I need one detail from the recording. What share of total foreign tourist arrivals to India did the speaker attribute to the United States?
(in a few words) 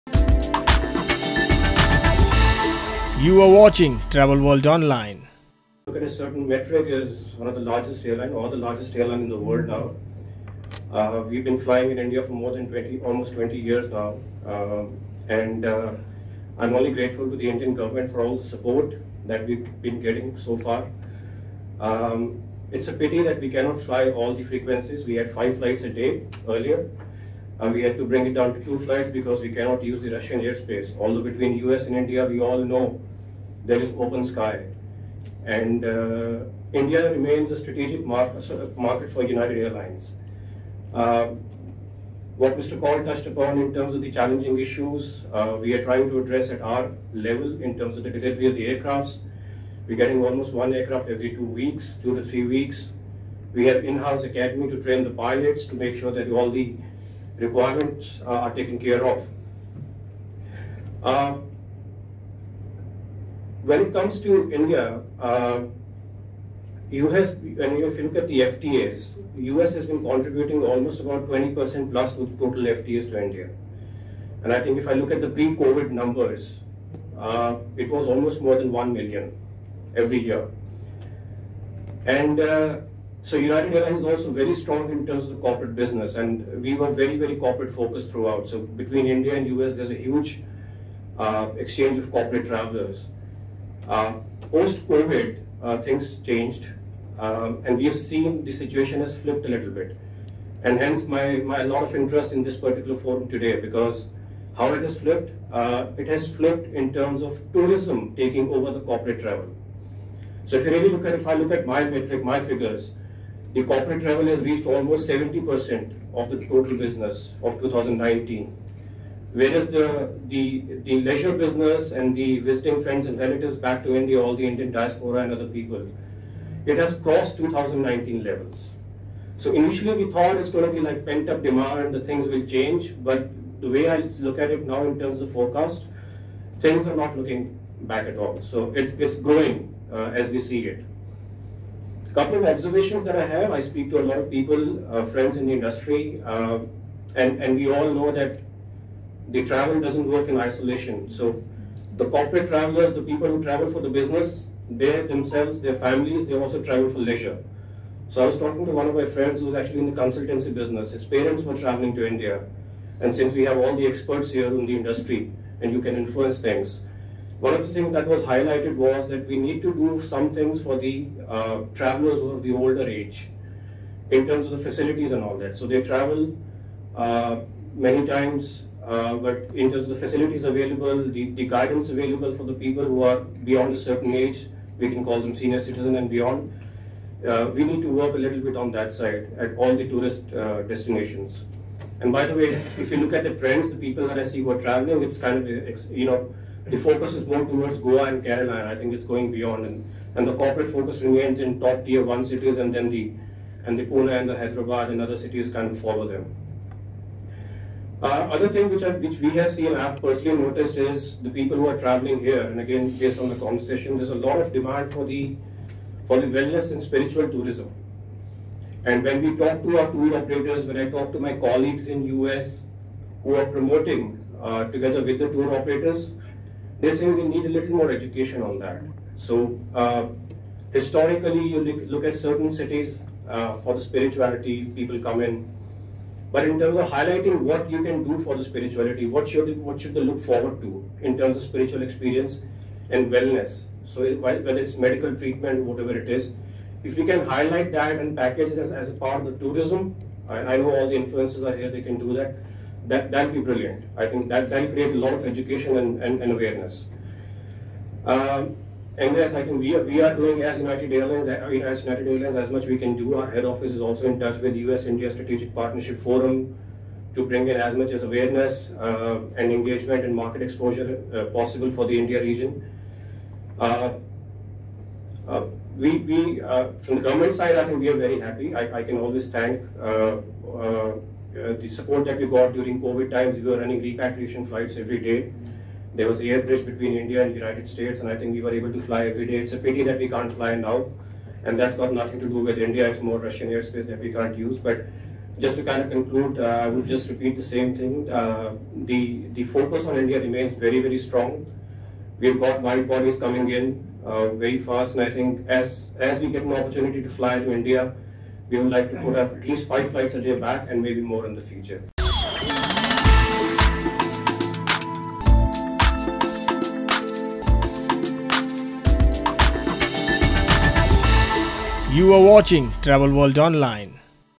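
20% plus.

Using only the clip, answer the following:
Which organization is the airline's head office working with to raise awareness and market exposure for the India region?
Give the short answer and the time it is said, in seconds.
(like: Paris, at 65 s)
U.S.-India Strategic Partnership Forum, at 264 s.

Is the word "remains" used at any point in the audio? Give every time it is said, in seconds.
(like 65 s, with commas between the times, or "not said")
37 s, 201 s, 300 s.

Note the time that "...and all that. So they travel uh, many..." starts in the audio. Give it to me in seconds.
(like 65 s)
175 s.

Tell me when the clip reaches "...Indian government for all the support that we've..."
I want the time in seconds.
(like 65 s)
17 s.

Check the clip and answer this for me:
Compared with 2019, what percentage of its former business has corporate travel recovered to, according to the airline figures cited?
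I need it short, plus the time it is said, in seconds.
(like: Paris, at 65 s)
70%, at 115 s.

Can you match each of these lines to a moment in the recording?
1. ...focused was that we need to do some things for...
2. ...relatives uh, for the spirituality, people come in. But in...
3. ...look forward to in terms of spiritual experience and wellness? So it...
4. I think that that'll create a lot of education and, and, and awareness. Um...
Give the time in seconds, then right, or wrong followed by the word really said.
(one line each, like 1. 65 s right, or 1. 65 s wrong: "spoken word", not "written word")
1. 168 s wrong: "highlighted", not "focused"
2. 232 s wrong: "cities", not "relatives"
3. 240 s right
4. 253 s right.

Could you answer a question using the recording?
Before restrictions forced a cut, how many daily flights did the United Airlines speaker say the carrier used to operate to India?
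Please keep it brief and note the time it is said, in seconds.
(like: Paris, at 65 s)
5, at 25 s.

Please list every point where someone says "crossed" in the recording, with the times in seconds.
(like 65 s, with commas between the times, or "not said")
126 s.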